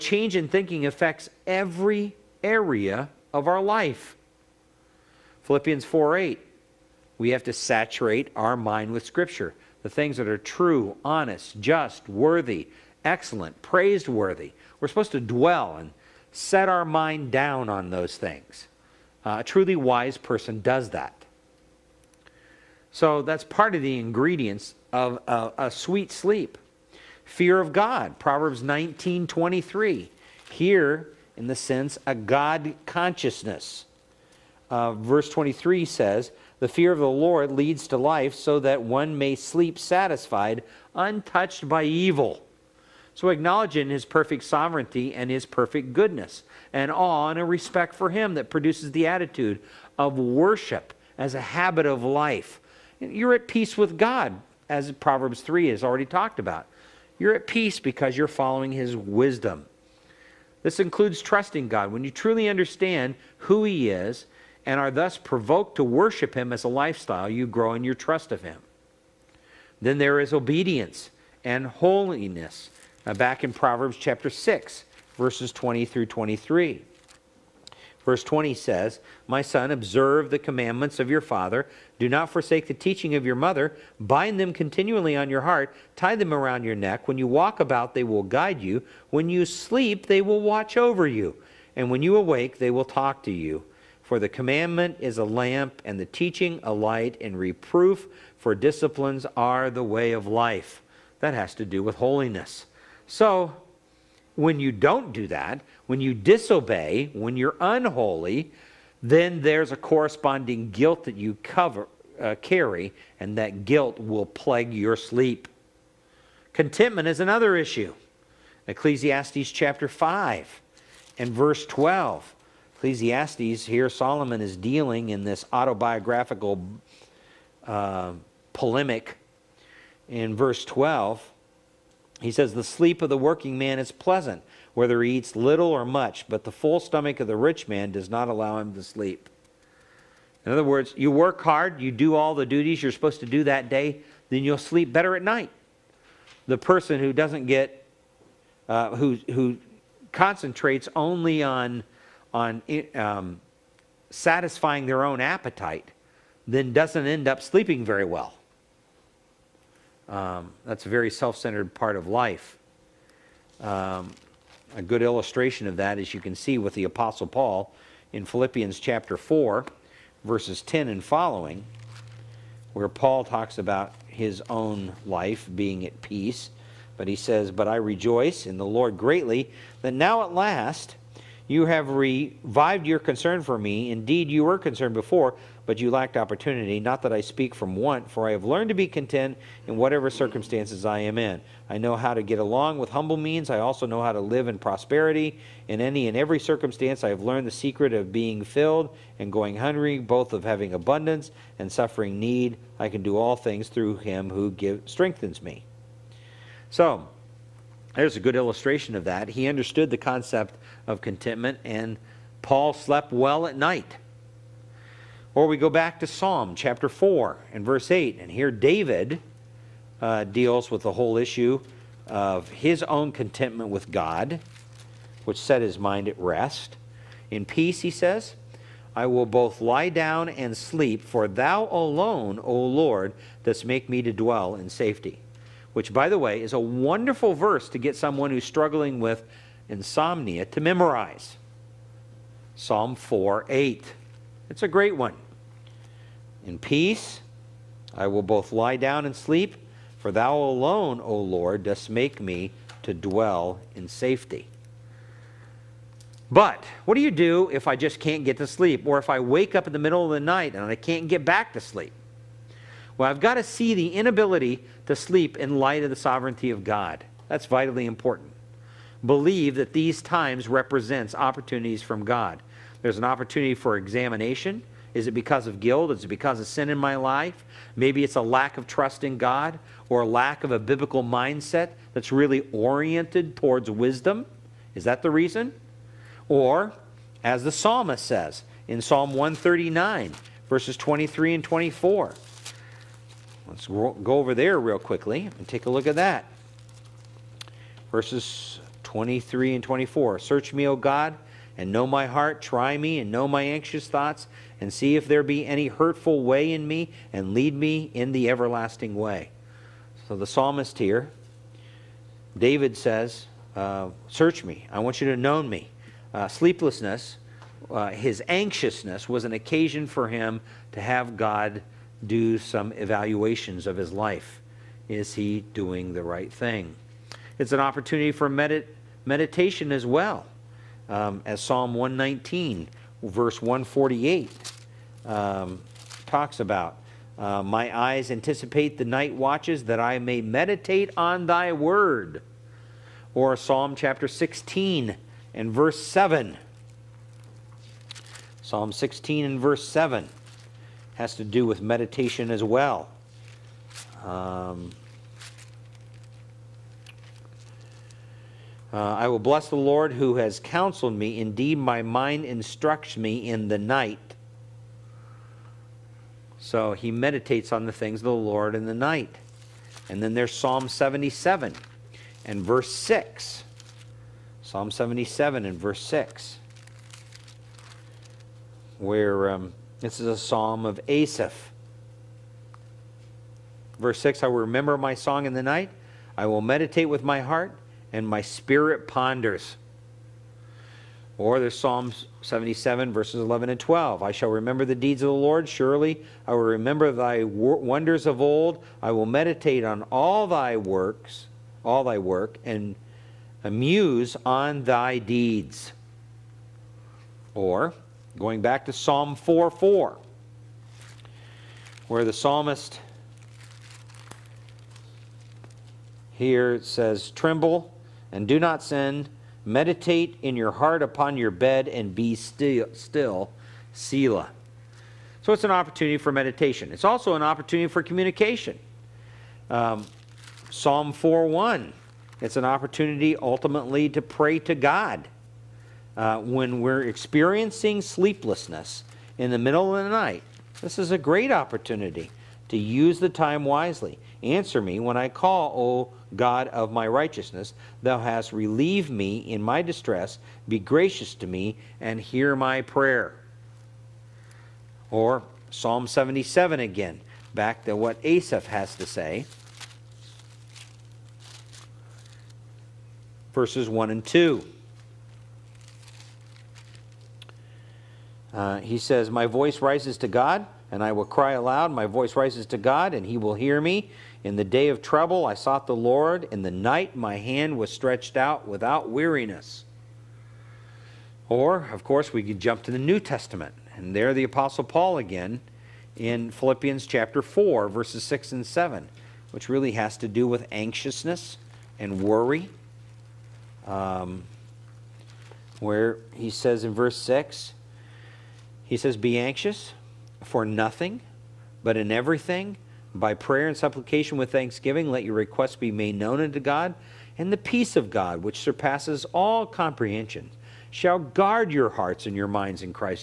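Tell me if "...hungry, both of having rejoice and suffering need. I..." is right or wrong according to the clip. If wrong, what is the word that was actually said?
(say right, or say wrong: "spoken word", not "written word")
wrong: "abundance", not "rejoice".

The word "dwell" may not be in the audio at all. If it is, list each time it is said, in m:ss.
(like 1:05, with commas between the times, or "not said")
0:15, 3:54, 4:12.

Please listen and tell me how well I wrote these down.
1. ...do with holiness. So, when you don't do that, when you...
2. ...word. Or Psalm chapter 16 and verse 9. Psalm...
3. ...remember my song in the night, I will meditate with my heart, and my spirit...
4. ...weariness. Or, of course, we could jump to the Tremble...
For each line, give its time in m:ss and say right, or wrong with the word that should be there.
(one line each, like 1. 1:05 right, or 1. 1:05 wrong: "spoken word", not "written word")
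1. 1:41 right
2. 5:41 wrong: "7", not "9"
3. 6:24 right
4. 7:58 wrong: "New", not "Tremble".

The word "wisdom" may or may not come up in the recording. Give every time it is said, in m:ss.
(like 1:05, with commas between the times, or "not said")
0:58, 4:43.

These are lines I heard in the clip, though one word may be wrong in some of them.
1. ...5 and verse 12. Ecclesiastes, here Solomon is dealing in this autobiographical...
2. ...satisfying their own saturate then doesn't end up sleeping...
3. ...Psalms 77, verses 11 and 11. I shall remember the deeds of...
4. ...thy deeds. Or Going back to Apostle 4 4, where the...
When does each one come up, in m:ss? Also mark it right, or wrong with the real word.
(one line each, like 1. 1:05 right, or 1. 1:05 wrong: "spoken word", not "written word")
1. 1:59 right
2. 2:34 wrong: "appetite", not "saturate"
3. 6:31 wrong: "12", not "11"
4. 6:44 wrong: "Psalm", not "Apostle".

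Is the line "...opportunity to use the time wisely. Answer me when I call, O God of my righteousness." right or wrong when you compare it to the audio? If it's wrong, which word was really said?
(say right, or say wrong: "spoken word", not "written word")
right.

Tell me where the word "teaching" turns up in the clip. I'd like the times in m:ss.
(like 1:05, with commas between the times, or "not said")
1:22, 1:36.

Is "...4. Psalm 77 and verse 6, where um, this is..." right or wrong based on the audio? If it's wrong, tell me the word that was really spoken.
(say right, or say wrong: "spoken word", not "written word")
wrong: "6", not "4".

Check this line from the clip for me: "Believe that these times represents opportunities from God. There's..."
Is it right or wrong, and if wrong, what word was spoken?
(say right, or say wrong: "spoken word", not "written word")
right.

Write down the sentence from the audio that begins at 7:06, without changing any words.
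It's also an opportunity for communication.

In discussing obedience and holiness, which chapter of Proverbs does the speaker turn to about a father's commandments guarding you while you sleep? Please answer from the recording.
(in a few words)
Proverbs chapter 6.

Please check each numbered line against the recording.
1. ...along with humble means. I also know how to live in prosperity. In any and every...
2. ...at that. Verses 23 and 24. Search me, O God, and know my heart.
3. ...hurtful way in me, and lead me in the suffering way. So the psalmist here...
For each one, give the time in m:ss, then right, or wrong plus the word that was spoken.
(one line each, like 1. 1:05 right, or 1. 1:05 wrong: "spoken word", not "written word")
1. 3:12 right
2. 4:55 right
3. 5:05 wrong: "everlasting", not "suffering".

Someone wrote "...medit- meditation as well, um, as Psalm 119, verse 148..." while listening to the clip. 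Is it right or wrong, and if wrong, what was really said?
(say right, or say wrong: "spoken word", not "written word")
right.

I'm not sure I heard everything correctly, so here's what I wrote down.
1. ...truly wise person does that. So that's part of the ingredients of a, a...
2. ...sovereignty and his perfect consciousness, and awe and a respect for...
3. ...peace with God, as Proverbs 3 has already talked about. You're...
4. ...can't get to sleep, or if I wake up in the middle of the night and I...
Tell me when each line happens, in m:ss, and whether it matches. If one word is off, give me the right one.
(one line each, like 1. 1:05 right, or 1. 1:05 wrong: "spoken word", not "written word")
1. 0:19 right
2. 0:44 wrong: "goodness", not "consciousness"
3. 0:53 right
4. 4:18 right.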